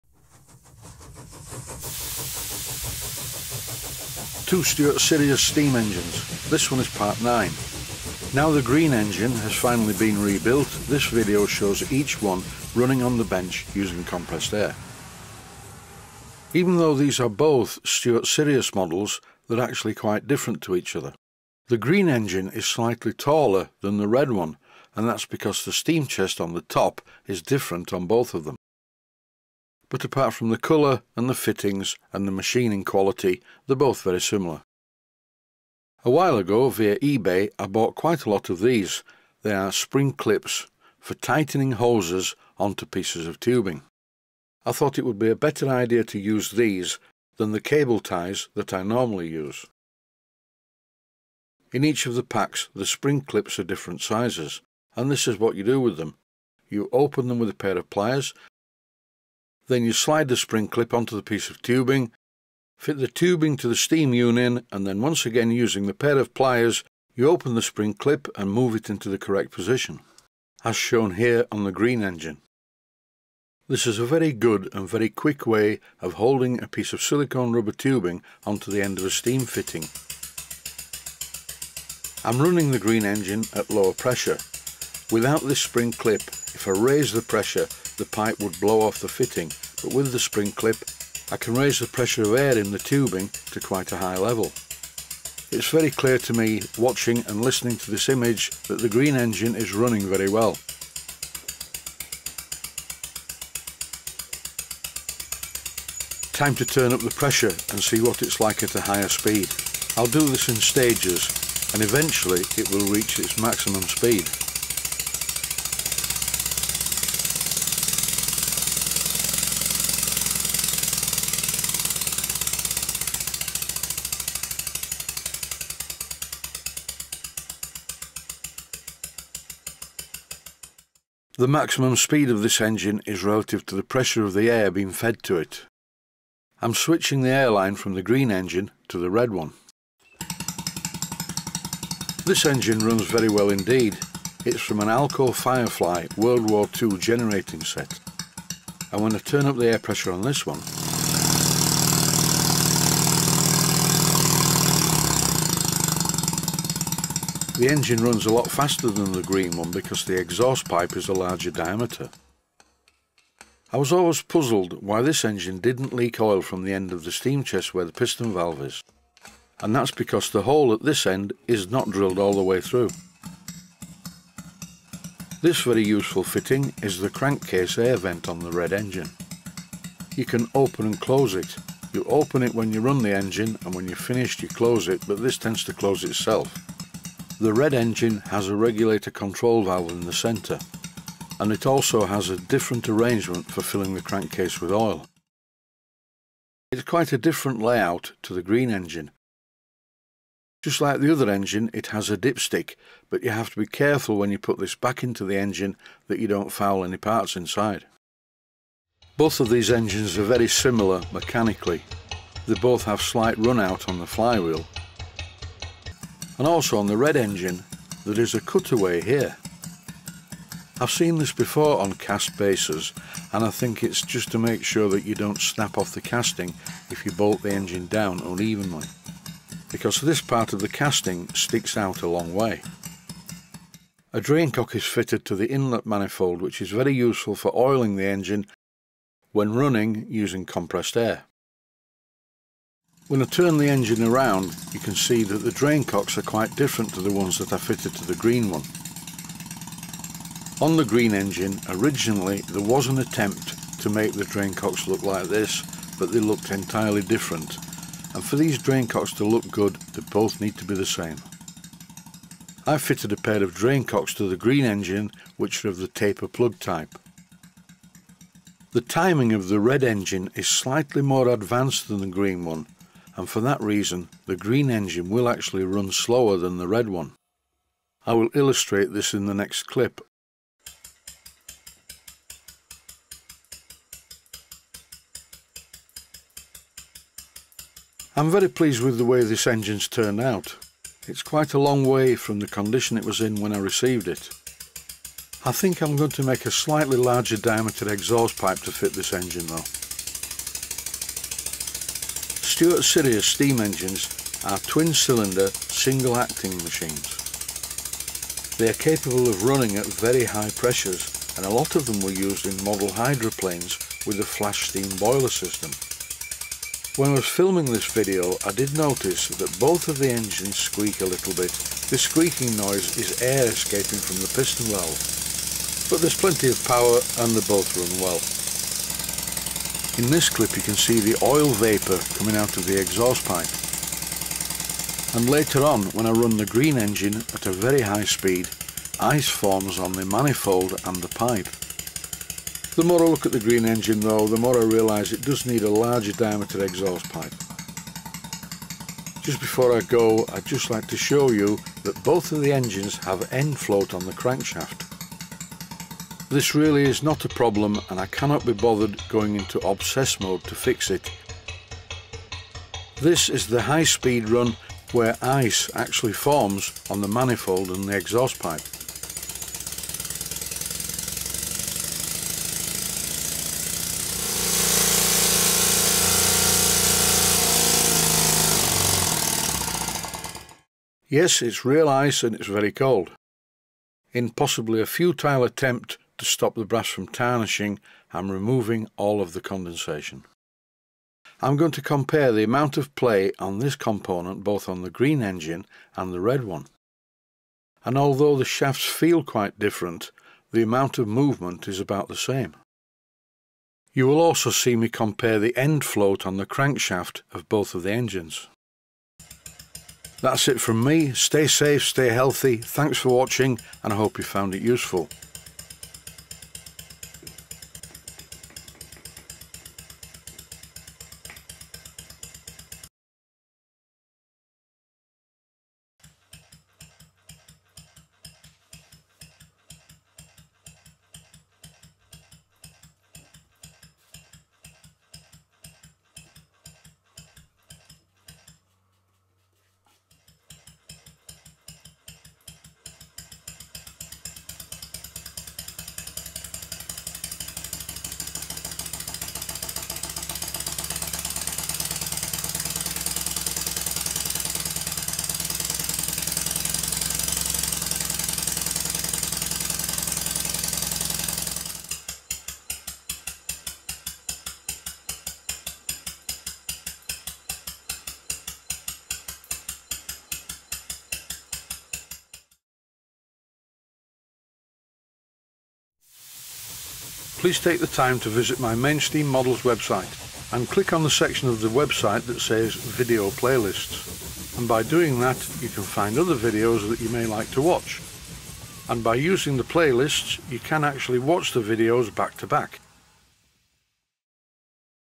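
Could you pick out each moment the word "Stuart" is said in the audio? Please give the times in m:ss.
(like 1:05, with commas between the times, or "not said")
0:04, 0:17, 5:02.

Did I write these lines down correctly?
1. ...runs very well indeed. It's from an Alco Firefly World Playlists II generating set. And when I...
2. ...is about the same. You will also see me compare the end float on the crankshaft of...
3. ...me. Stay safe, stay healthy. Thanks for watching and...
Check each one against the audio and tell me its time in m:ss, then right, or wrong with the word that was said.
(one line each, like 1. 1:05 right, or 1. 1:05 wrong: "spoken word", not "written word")
1. 2:22 wrong: "War", not "Playlists"
2. 6:41 right
3. 6:50 right.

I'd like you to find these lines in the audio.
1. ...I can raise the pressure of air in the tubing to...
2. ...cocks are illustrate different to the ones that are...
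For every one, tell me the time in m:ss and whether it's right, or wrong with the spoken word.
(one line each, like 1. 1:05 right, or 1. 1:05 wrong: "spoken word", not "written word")
1. 1:31 right
2. 4:05 wrong: "quite", not "illustrate".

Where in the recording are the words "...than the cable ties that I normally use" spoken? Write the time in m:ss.
0:47.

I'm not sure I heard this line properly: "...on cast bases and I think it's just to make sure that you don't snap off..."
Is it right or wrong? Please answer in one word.
right.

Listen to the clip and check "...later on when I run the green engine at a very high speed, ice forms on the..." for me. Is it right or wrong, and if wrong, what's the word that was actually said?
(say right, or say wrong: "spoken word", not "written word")
right.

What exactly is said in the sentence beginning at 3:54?
A drain cock is fitted to the inlet manifold which is very useful for oiling the engine when running using compressed air.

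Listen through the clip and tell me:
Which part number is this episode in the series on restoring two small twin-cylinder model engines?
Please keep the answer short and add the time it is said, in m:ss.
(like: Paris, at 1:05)
Part 9, at 0:06.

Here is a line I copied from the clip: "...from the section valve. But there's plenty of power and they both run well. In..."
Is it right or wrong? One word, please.
wrong.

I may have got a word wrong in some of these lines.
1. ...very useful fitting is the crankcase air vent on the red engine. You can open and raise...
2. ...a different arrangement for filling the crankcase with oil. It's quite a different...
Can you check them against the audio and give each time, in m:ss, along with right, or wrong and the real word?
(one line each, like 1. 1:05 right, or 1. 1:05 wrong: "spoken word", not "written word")
1. 2:55 wrong: "close", not "raise"
2. 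3:12 right.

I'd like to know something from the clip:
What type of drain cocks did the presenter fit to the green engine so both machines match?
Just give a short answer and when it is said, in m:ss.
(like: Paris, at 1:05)
Taper plug type, at 4:25.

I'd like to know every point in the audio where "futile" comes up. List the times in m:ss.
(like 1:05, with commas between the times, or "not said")
6:24.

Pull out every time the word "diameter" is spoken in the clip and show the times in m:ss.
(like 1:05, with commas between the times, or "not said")
2:41, 4:57, 5:46.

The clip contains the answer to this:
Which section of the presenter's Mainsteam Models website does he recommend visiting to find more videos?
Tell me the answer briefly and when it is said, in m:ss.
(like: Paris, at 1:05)
Video Playlists, at 8:02.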